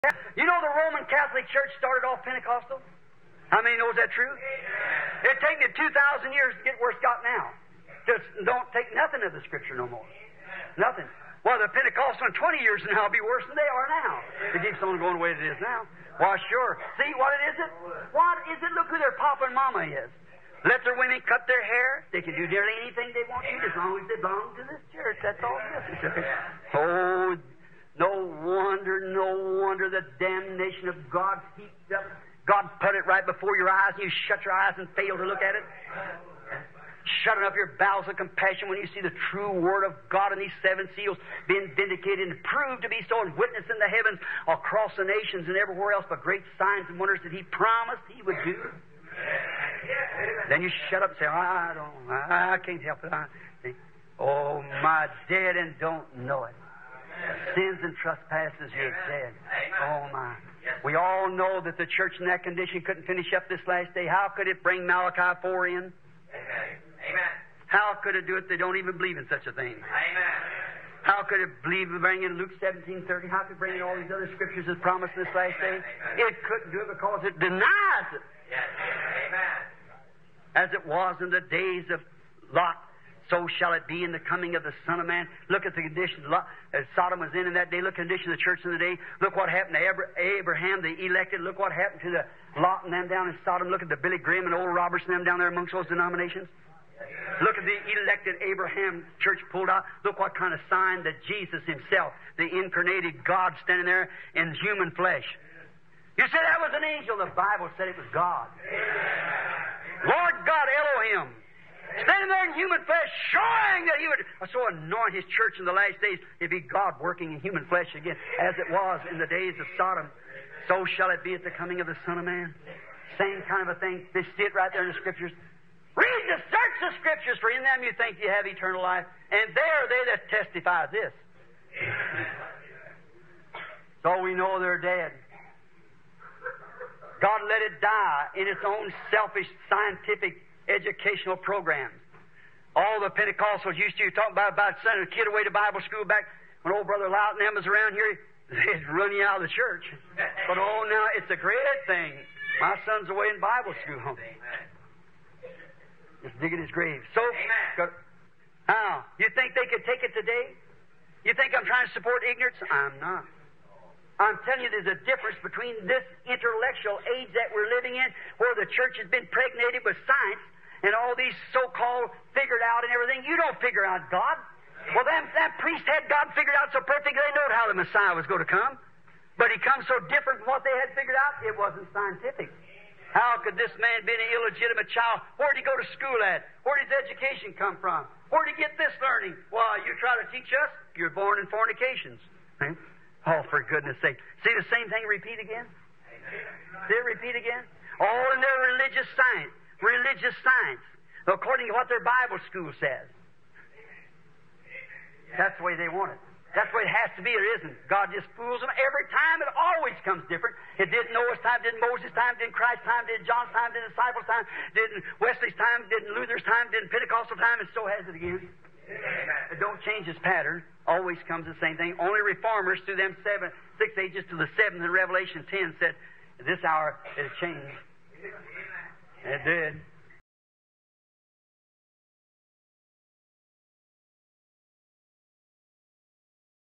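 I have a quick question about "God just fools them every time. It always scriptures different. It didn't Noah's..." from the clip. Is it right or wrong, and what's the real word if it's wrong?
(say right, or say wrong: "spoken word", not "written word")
wrong: "comes", not "scriptures".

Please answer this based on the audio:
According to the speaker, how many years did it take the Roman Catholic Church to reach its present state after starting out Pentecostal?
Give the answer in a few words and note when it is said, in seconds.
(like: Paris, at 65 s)
2,000, at 5 s.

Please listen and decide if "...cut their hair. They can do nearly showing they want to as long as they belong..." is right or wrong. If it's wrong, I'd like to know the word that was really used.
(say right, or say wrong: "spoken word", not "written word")
wrong: "anything", not "showing".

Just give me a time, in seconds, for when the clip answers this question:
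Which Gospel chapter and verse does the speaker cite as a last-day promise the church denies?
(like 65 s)
72 s.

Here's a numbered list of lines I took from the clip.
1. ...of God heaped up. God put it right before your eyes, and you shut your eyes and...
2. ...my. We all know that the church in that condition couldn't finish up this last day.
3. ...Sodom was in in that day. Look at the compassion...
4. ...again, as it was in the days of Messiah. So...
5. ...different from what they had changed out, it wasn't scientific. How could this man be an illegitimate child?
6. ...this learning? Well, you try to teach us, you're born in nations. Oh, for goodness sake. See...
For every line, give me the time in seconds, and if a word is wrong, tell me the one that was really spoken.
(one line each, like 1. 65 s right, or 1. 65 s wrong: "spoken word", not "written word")
1. 30 s right
2. 60 s right
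3. 86 s wrong: "condition", not "compassion"
4. 117 s wrong: "Sodom", not "Messiah"
5. 180 s wrong: "figured", not "changed"
6. 188 s wrong: "fornications", not "nations".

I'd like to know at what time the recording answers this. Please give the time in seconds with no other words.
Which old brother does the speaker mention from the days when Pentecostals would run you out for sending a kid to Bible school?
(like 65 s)
146 s.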